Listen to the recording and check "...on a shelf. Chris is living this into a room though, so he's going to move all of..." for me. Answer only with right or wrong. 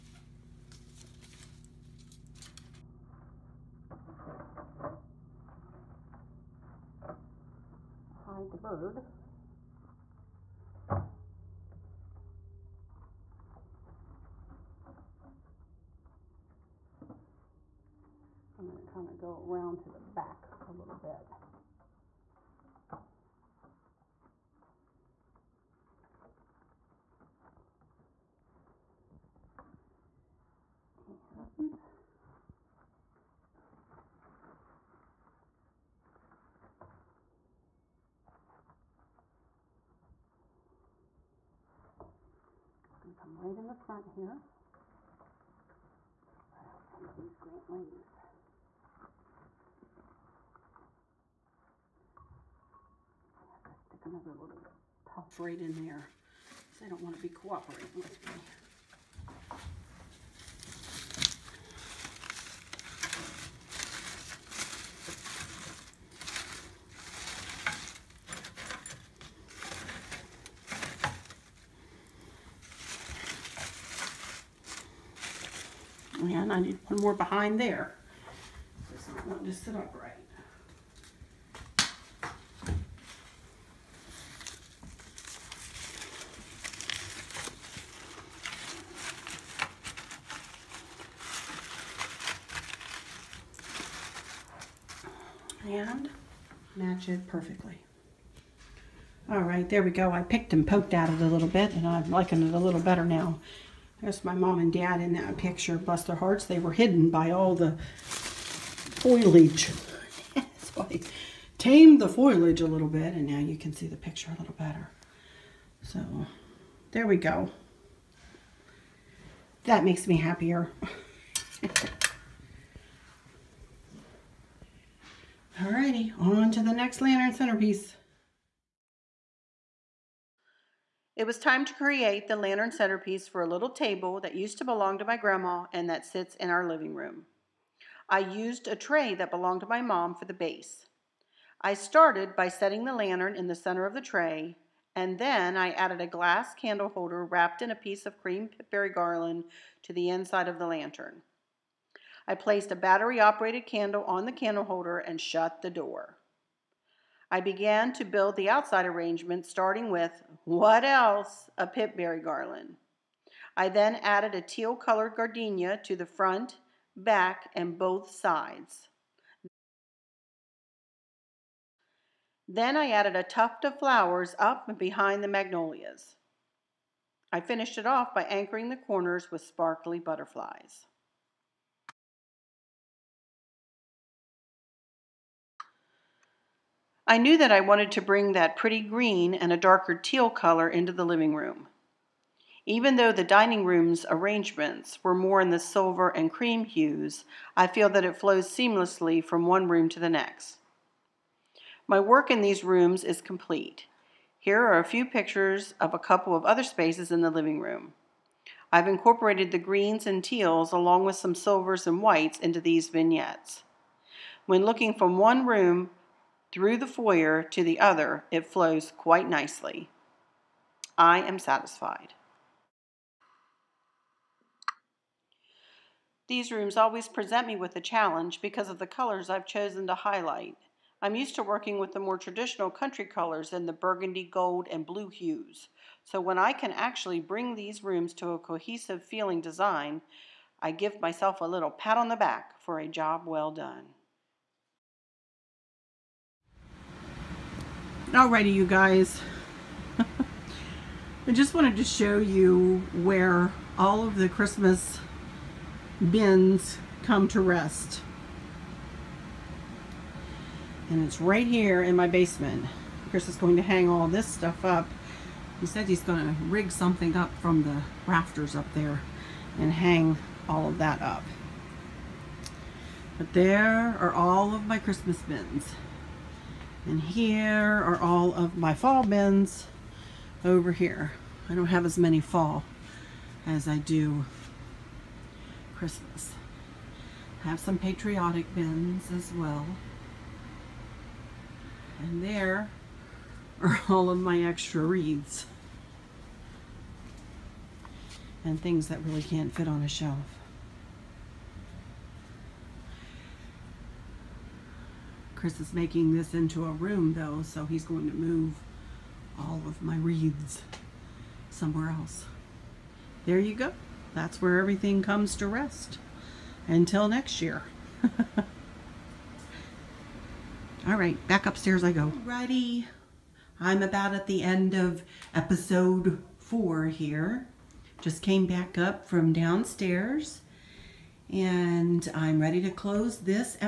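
wrong.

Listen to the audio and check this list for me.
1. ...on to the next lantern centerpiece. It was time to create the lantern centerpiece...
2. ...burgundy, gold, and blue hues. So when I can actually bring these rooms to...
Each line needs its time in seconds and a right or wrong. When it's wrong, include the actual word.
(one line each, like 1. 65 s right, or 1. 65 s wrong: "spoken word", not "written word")
1. 126 s right
2. 233 s right.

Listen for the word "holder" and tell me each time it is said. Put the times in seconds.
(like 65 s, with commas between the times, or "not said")
146 s, 154 s.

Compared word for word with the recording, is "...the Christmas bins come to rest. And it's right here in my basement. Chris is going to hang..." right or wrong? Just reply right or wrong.
right.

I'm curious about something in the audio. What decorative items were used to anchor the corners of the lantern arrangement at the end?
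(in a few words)
Sparkly butterflies.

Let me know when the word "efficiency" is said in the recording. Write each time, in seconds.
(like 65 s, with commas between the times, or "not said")
not said.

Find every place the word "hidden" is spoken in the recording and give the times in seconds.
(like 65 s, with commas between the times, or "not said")
106 s.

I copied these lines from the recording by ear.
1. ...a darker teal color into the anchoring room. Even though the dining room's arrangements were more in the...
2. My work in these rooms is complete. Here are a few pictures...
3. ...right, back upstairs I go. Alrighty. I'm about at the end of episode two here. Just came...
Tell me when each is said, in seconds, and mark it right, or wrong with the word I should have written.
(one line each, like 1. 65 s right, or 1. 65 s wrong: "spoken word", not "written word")
1. 189 s wrong: "living", not "anchoring"
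2. 201 s right
3. 320 s wrong: "four", not "two".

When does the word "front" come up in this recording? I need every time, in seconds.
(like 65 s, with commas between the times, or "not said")
43 s, 166 s.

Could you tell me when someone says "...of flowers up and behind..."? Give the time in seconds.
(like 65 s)
173 s.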